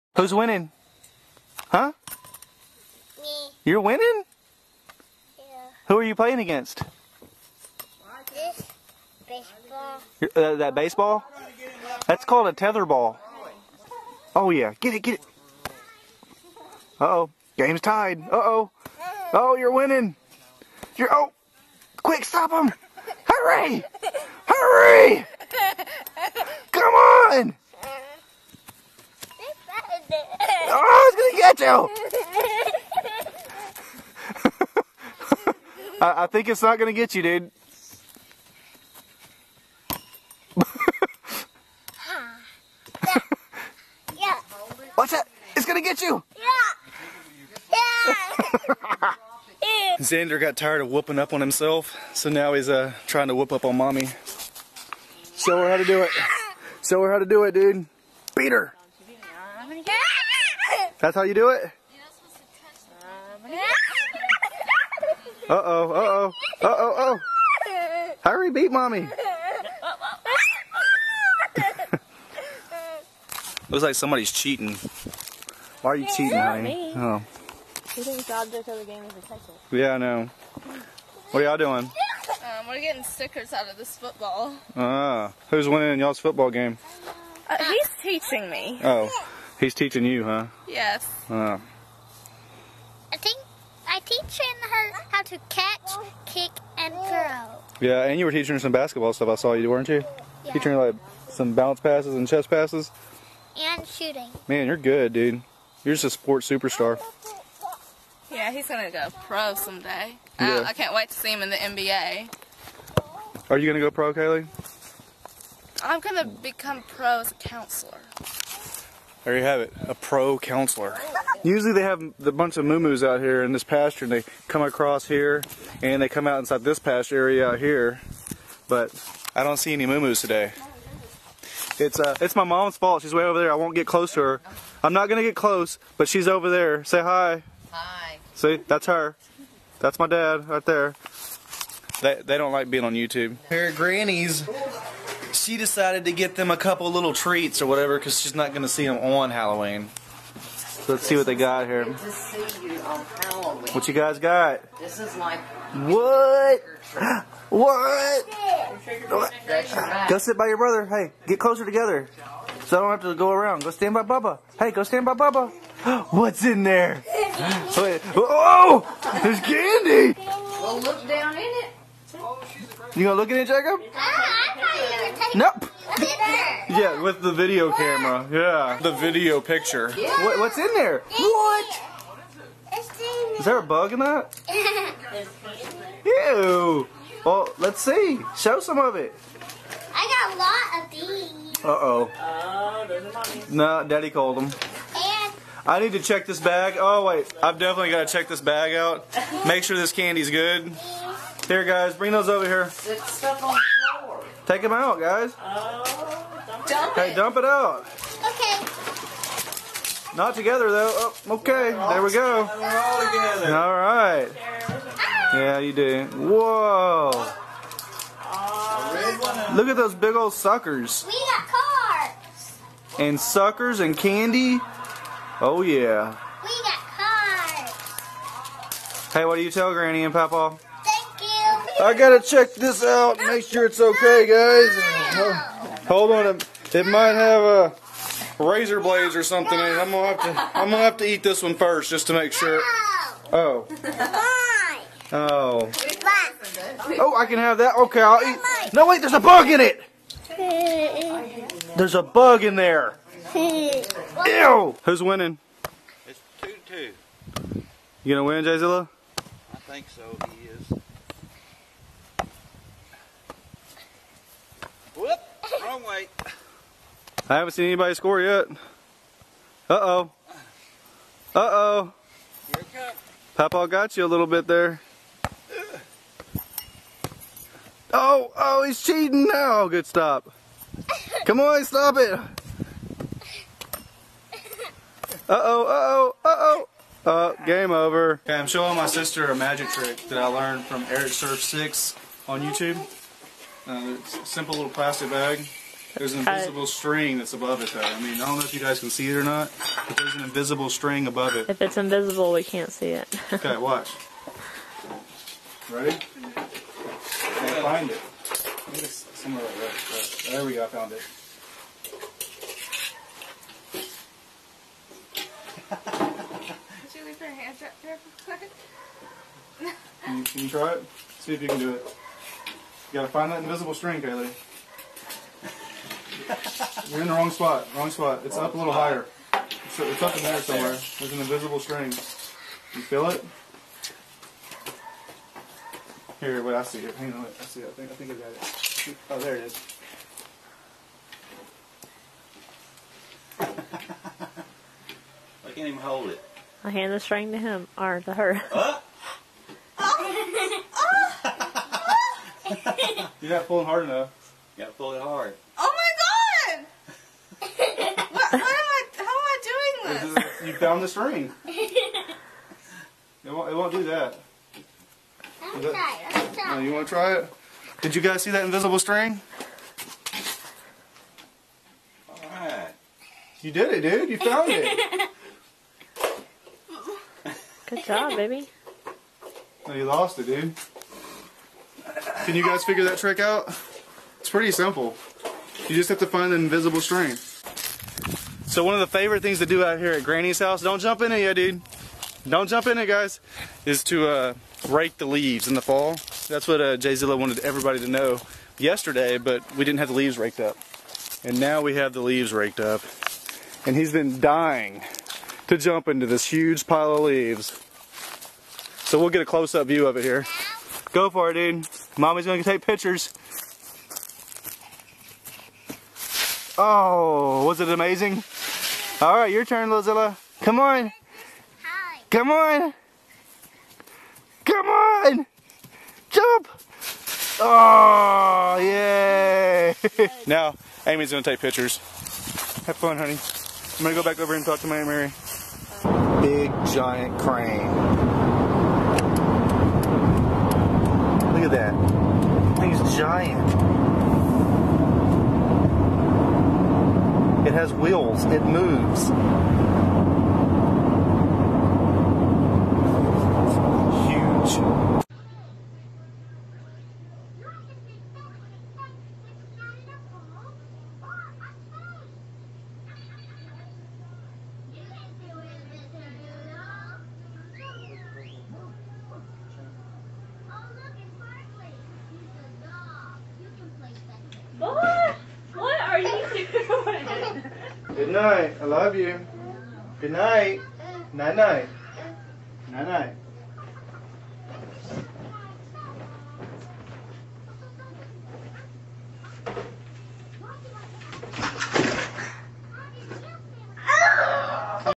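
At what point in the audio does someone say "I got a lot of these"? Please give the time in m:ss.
3:09.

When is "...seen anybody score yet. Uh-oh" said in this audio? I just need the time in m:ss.
4:27.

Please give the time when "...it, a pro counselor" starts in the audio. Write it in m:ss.
1:59.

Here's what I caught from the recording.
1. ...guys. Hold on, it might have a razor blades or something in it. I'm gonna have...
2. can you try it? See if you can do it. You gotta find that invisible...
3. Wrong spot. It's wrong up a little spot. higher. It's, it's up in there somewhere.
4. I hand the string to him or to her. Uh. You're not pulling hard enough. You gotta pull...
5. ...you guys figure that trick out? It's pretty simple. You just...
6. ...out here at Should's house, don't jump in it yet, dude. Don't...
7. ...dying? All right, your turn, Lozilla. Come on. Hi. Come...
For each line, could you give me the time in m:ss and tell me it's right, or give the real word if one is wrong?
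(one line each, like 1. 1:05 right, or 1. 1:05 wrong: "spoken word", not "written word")
1. 3:54 right
2. 5:20 right
3. 5:27 right
4. 5:46 right
5. 6:22 right
6. 6:29 wrong: "Granny", not "Should"
7. 6:57 wrong: "amazing", not "dying".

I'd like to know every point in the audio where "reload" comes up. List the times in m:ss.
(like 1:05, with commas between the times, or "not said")
not said.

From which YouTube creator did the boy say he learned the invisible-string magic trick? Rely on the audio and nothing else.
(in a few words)
EricSurf6.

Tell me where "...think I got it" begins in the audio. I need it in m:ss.
5:37.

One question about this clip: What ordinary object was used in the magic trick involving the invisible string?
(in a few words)
Plastic bag.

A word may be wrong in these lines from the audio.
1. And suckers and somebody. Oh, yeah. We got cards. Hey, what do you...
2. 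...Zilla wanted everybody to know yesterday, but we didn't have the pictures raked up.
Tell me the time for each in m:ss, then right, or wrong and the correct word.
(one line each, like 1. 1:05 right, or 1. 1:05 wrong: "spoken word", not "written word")
1. 3:42 wrong: "candy", not "somebody"
2. 6:36 wrong: "leaves", not "pictures".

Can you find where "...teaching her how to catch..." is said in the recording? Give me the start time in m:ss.
1:33.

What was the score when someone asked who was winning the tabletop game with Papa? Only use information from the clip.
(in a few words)
2-2.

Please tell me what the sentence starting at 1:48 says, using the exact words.
Yeah, he's gonna go pro someday.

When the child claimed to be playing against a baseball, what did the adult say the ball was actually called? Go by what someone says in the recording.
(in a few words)
Tether ball.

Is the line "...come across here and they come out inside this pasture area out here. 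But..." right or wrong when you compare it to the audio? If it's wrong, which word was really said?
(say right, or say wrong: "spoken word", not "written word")
right.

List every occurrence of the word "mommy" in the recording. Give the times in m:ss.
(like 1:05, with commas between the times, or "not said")
0:53, 1:08, 6:51.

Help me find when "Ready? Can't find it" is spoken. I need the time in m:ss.
5:05.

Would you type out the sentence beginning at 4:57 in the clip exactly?
I mean, I don't know if you guys can see it or not, but there's an invisible string above it.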